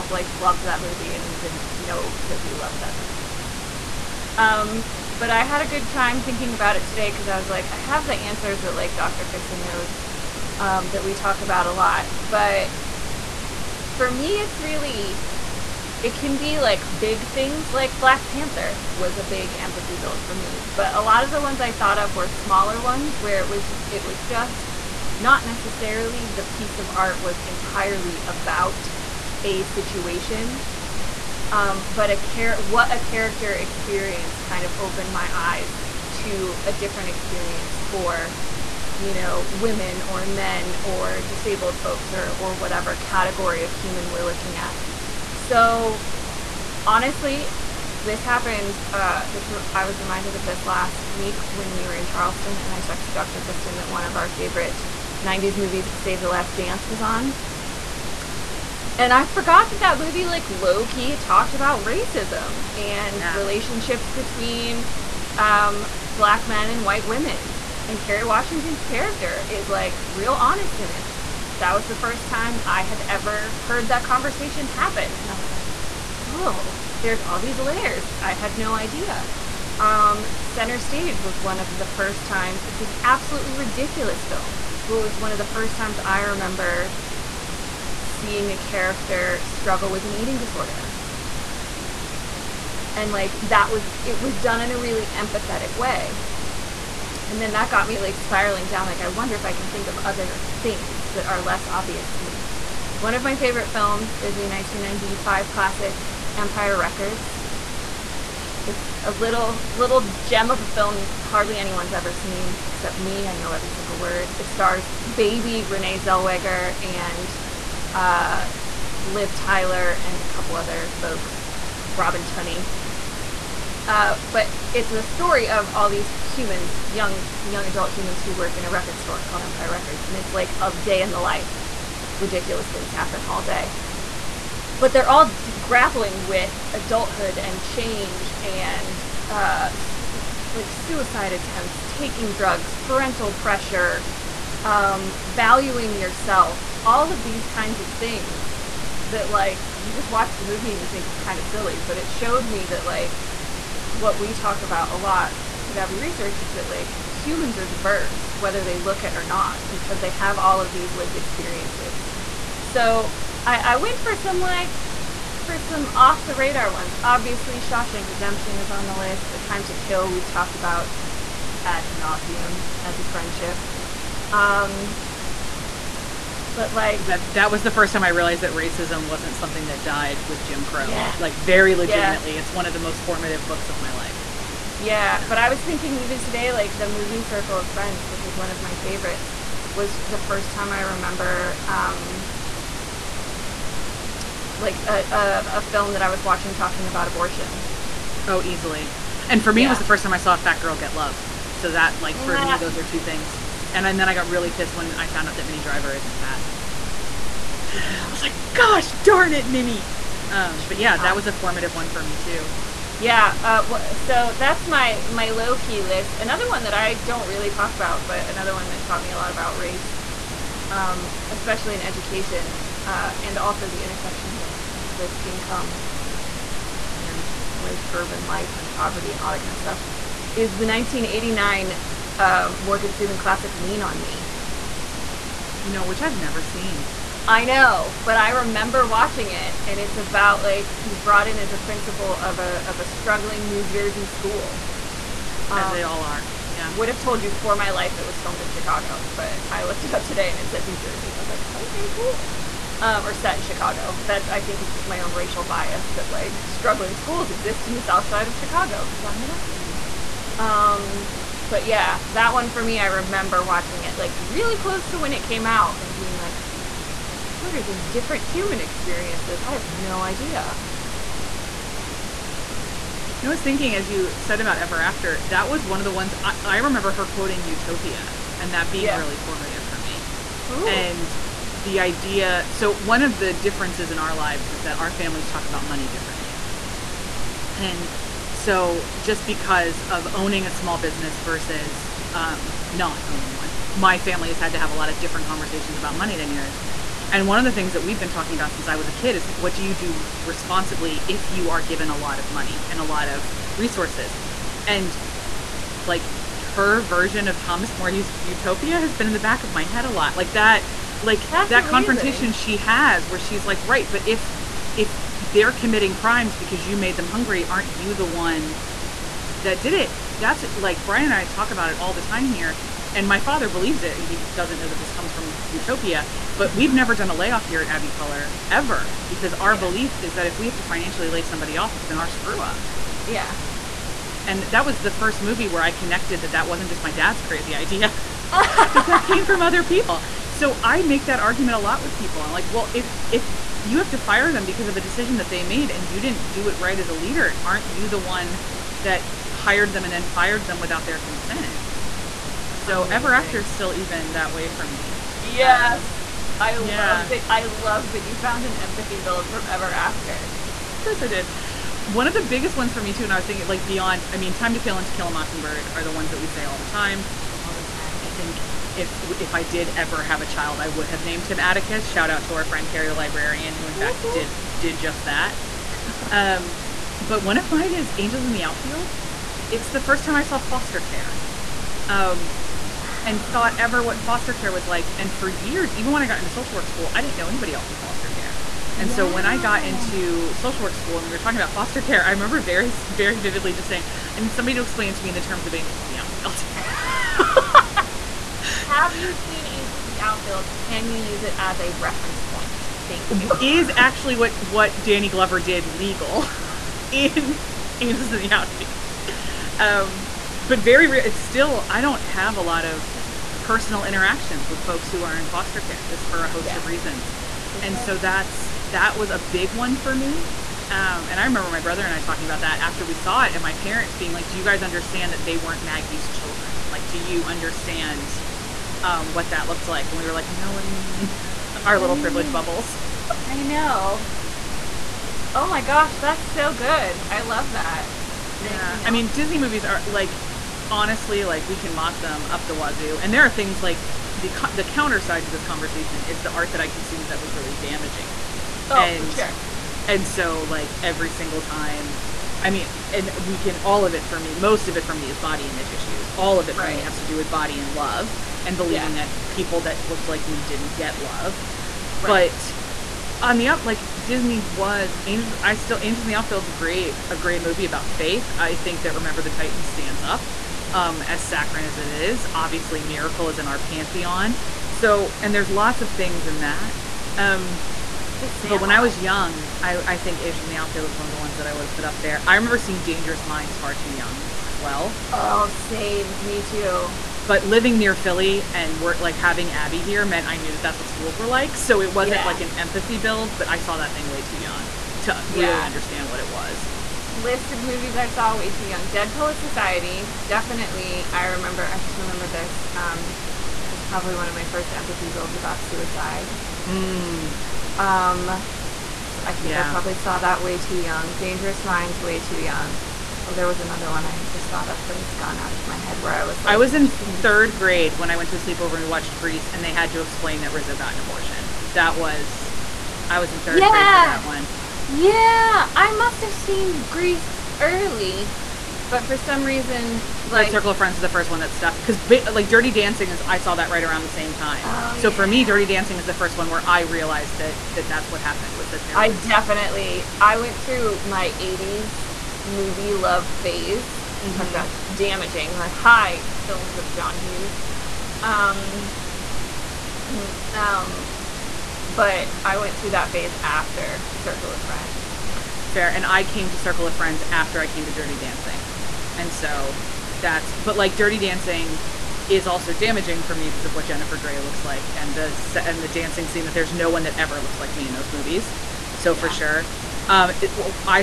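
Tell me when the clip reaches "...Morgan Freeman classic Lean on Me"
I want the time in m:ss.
3:52.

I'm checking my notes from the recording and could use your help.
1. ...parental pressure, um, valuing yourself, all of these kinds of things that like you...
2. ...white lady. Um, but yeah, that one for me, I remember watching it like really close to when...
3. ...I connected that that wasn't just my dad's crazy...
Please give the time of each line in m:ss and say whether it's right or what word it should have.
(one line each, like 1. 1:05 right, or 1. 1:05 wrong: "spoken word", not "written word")
1. 2:22 right
2. 4:19 right
3. 5:35 right.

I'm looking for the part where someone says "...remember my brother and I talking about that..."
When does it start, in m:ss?
7:01.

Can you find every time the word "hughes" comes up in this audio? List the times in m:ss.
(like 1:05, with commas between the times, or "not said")
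9:07.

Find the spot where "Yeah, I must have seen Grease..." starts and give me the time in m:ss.
8:44.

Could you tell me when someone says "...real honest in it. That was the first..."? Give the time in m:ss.
1:10.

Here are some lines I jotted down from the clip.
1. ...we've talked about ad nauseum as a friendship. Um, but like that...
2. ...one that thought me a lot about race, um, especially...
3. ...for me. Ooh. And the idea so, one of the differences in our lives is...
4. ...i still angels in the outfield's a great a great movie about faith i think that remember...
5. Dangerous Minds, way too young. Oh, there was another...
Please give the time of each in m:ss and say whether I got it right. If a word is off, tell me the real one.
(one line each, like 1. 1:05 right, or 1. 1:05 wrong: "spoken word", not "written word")
1. 2:50 right
2. 3:38 wrong: "taught", not "thought"
3. 4:39 right
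4. 7:45 right
5. 8:31 right.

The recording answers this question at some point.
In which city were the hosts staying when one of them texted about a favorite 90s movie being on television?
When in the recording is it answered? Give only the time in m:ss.
0:52.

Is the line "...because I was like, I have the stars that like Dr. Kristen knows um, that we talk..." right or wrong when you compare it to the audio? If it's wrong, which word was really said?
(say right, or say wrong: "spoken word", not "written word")
wrong: "answers", not "stars".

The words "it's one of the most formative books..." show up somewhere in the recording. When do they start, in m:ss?
3:02.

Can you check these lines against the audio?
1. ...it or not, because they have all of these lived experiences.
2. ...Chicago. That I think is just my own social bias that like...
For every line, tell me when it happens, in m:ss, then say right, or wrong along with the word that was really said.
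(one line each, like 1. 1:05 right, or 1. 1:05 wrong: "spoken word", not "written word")
1. 2:39 right
2. 4:13 wrong: "racial", not "social".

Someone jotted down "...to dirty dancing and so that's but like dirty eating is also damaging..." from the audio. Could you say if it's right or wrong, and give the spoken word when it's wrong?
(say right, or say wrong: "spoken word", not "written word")
wrong: "dancing", not "eating".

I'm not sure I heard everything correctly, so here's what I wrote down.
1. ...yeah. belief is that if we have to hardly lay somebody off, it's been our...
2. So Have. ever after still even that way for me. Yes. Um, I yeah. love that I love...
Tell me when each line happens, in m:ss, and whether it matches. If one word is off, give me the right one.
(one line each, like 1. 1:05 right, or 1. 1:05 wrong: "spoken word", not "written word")
1. 5:29 wrong: "financially", not "hardly"
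2. 5:52 wrong: "Amazing", not "Have".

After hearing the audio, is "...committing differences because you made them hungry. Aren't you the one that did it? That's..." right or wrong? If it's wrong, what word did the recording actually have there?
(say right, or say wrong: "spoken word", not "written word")
wrong: "crimes", not "differences".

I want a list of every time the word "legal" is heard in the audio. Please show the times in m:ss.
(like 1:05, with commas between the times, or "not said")
6:45.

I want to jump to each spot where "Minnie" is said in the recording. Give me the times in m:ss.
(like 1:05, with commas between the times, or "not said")
3:25, 3:29.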